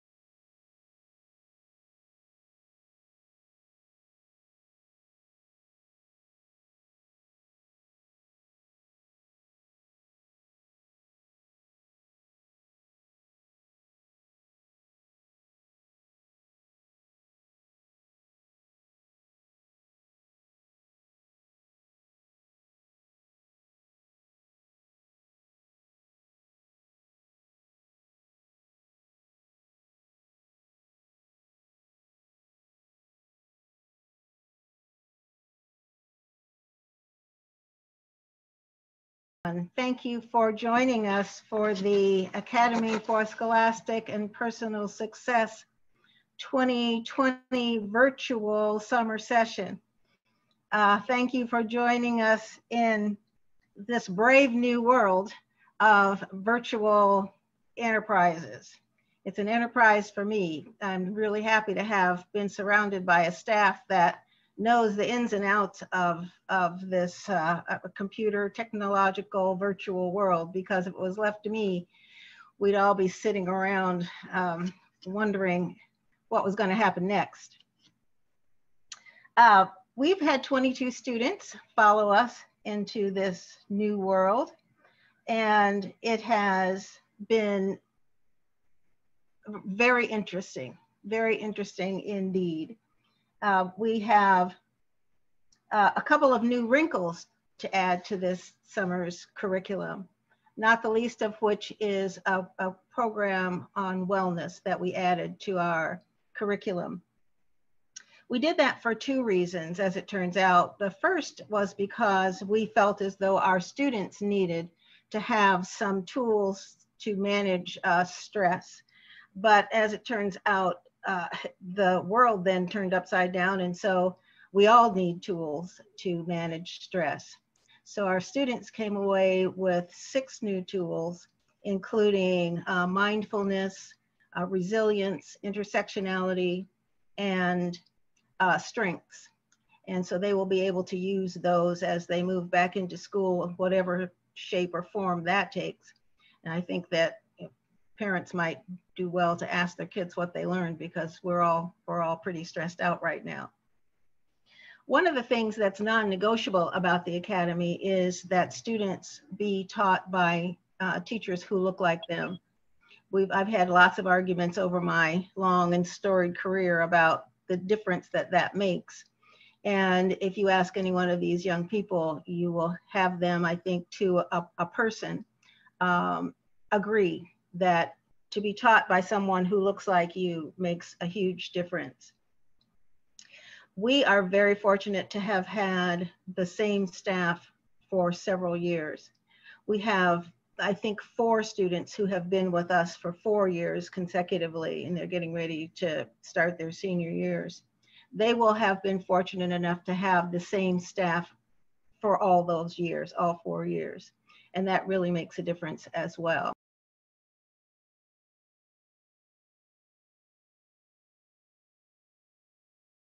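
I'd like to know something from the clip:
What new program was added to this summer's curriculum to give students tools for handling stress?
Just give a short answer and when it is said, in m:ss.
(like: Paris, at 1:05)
wellness, at 1:44.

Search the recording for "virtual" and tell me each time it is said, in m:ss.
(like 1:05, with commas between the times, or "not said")
0:47, 0:56, 1:09.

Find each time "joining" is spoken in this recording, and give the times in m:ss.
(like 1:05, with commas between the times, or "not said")
0:40, 0:51.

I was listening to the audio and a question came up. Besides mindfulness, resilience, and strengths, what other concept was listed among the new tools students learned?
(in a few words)
intersectionality.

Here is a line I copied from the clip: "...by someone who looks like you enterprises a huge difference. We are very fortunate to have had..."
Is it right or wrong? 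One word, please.
wrong.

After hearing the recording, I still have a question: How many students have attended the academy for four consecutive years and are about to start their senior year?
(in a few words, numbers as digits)
4.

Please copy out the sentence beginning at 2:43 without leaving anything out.
We've I've had lots of arguments over my long and storied career about the difference that that makes.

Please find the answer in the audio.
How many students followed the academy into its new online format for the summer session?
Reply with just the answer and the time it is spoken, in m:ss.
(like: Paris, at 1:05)
22, at 1:20.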